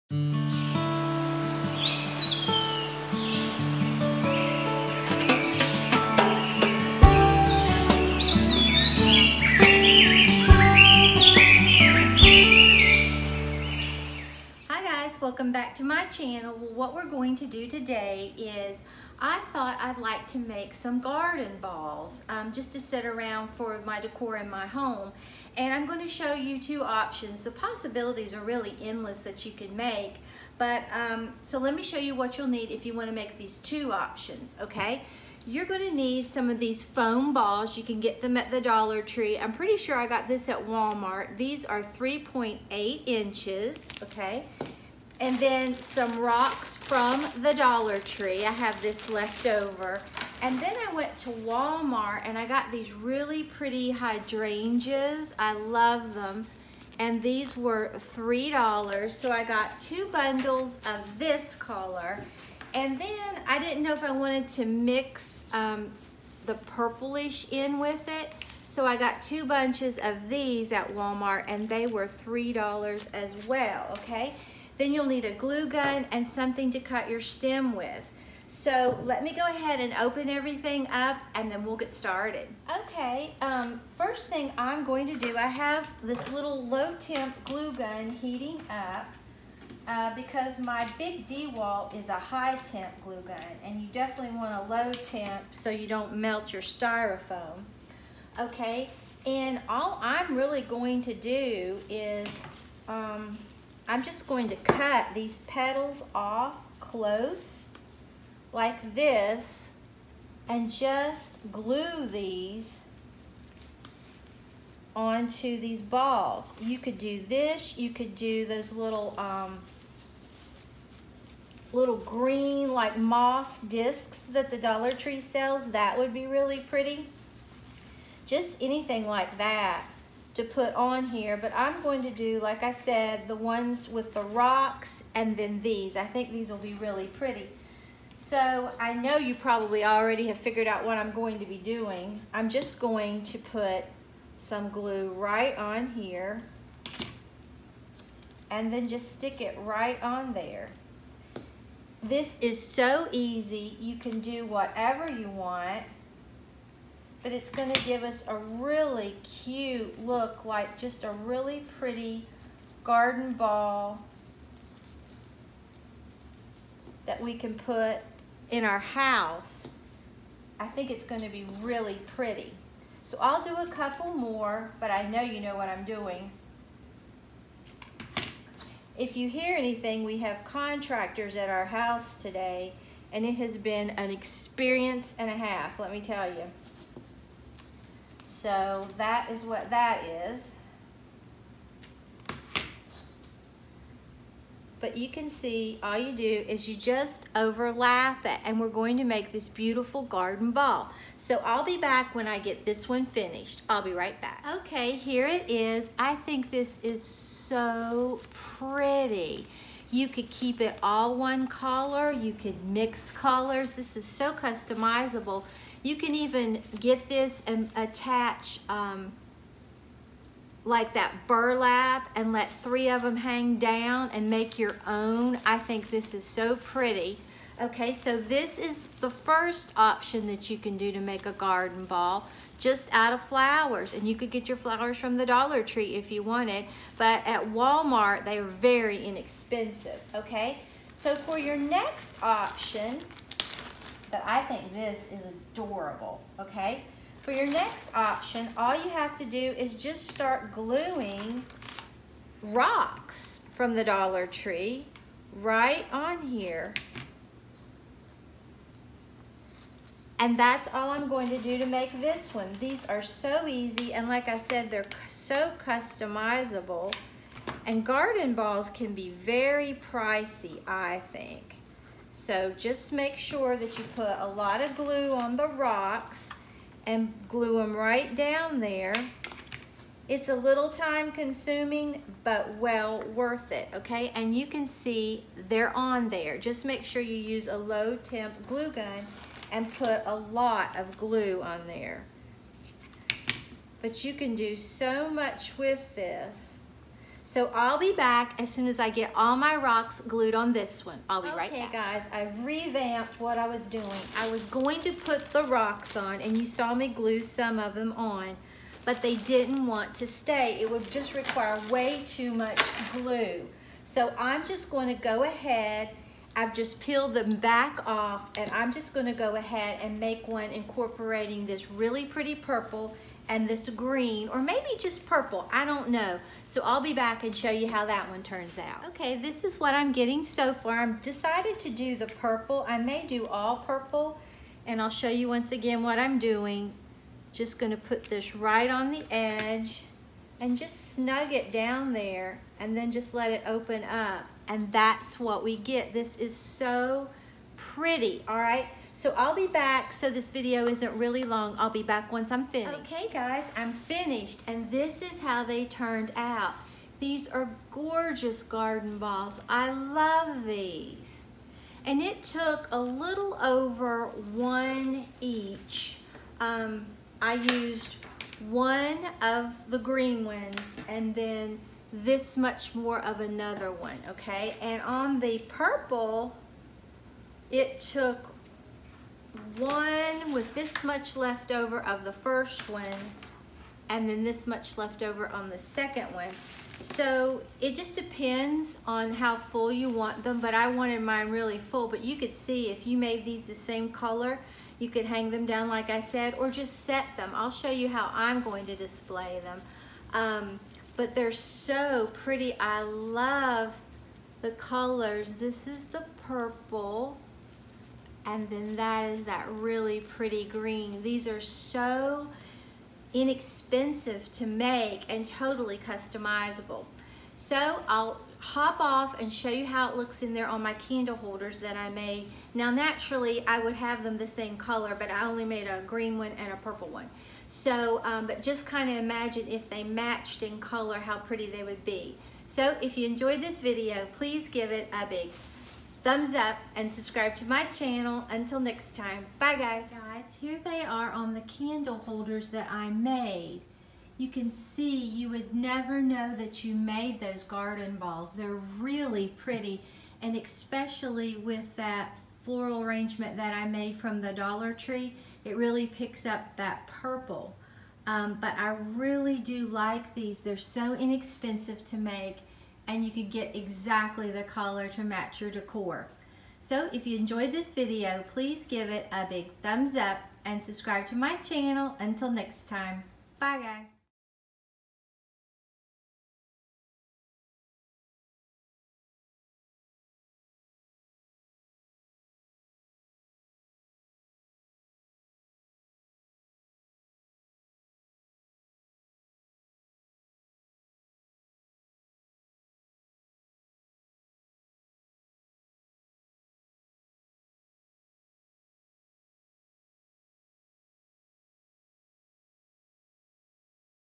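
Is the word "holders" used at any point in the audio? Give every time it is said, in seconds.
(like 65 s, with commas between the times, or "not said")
421 s, 441 s.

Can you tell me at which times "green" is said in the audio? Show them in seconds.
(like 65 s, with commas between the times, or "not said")
121 s, 323 s, 369 s, 410 s, 425 s.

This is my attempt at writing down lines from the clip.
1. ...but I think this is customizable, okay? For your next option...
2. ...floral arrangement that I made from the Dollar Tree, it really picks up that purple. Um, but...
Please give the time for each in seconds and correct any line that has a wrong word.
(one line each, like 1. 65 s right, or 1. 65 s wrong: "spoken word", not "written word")
1. 244 s wrong: "adorable", not "customizable"
2. 452 s right.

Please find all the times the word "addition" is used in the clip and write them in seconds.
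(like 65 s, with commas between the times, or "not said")
not said.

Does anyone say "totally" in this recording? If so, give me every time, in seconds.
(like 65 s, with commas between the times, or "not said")
415 s.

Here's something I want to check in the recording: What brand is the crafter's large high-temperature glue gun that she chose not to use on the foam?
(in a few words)
DeWalt.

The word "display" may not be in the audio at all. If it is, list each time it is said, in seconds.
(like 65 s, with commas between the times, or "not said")
398 s.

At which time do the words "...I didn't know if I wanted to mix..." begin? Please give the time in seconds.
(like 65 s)
63 s.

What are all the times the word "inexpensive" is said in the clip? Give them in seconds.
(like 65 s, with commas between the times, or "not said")
239 s, 413 s, 460 s.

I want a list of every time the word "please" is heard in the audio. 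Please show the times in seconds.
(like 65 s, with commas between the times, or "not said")
434 s, 468 s.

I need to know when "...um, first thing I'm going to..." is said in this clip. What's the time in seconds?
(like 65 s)
83 s.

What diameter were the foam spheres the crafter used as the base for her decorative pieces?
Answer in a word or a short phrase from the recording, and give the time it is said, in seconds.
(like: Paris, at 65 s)
3.8 inches, at 41 s.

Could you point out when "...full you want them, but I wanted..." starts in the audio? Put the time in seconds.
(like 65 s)
389 s.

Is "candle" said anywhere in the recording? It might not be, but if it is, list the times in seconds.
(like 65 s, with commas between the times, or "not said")
420 s, 441 s.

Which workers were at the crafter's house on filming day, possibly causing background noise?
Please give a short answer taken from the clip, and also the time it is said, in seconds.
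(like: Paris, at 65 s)
contractors, at 180 s.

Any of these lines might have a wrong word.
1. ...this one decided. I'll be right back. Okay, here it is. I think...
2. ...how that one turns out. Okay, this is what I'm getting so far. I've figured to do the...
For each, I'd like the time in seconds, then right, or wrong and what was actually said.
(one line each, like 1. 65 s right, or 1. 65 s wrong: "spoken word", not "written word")
1. 202 s wrong: "finished", not "decided"
2. 327 s wrong: "decided", not "figured".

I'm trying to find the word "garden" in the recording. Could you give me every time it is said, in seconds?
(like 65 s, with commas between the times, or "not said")
20 s, 162 s, 200 s, 231 s, 267 s, 358 s, 447 s.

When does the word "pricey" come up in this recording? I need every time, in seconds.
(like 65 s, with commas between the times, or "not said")
269 s.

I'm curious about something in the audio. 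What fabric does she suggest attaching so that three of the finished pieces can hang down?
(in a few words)
burlap.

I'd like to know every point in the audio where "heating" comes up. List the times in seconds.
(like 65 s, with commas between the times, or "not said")
88 s.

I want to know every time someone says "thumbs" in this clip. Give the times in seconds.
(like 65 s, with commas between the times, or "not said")
436 s, 469 s.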